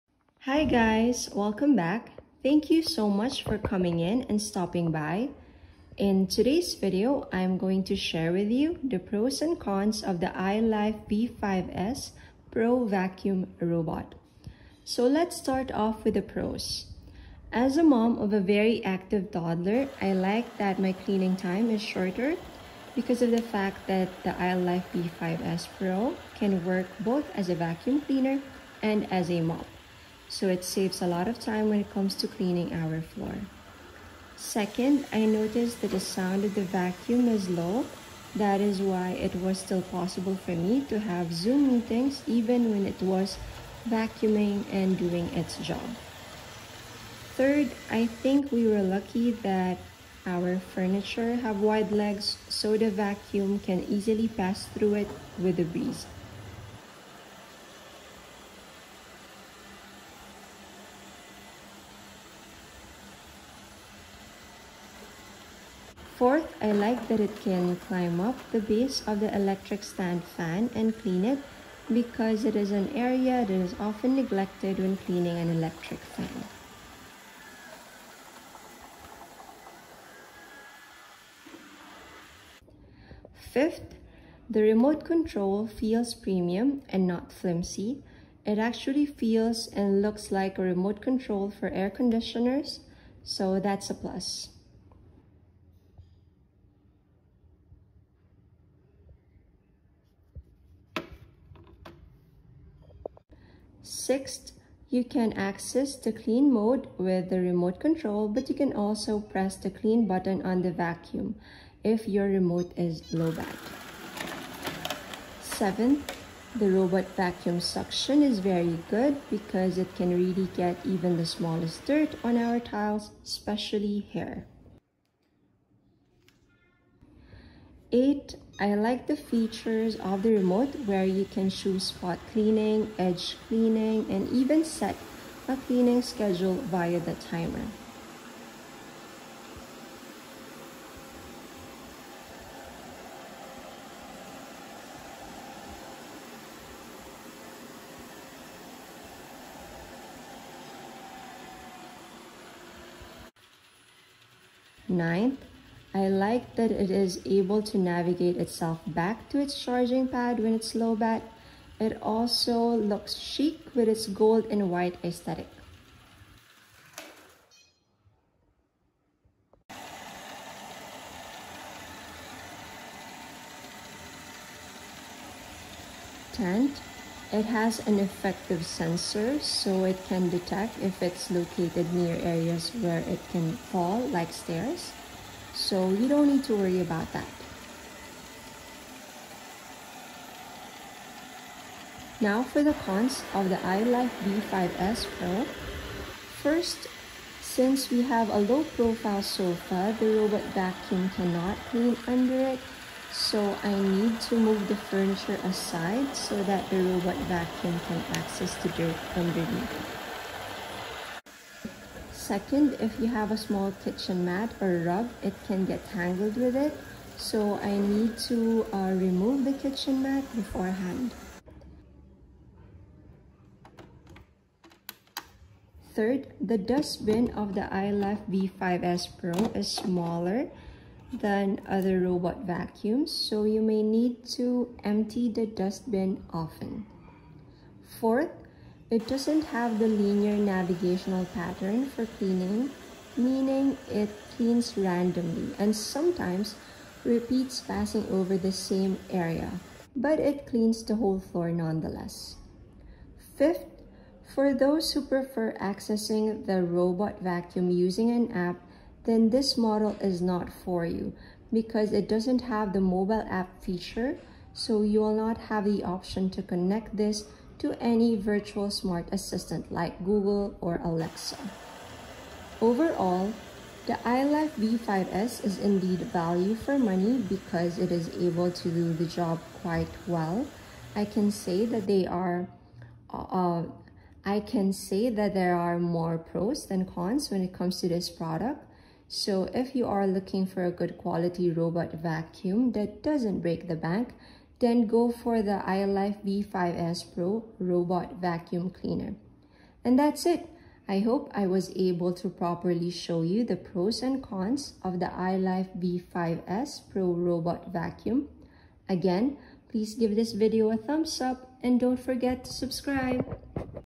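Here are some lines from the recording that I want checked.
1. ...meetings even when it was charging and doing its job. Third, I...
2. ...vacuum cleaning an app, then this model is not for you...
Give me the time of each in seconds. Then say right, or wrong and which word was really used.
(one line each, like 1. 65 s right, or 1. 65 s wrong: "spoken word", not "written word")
1. 41 s wrong: "vacuuming", not "charging"
2. 257 s wrong: "using", not "cleaning".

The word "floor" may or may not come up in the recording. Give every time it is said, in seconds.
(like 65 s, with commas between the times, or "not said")
33 s, 251 s.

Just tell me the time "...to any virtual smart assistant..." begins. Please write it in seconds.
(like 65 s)
267 s.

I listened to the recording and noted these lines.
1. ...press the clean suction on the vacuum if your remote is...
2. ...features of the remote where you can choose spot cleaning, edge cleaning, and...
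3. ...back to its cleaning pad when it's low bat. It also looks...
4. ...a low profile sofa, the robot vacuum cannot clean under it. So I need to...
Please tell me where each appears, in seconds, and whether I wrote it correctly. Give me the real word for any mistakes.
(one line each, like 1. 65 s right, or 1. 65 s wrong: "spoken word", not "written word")
1. 109 s wrong: "button", not "suction"
2. 129 s right
3. 158 s wrong: "charging", not "cleaning"
4. 198 s right.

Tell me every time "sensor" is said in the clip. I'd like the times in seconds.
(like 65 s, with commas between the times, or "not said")
178 s.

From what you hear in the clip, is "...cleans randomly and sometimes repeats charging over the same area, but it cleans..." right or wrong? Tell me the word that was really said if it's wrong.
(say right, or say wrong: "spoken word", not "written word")
wrong: "passing", not "charging".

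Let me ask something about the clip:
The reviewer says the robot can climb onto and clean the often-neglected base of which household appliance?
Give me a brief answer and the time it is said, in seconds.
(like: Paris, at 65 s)
electric stand fan, at 69 s.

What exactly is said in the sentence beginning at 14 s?
So let's start off with the pros.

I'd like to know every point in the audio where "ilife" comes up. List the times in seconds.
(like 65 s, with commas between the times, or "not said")
10 s, 24 s, 193 s, 227 s, 274 s, 295 s, 305 s.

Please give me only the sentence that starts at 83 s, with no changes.
Fifth, the remote control feels premium and not flimsy.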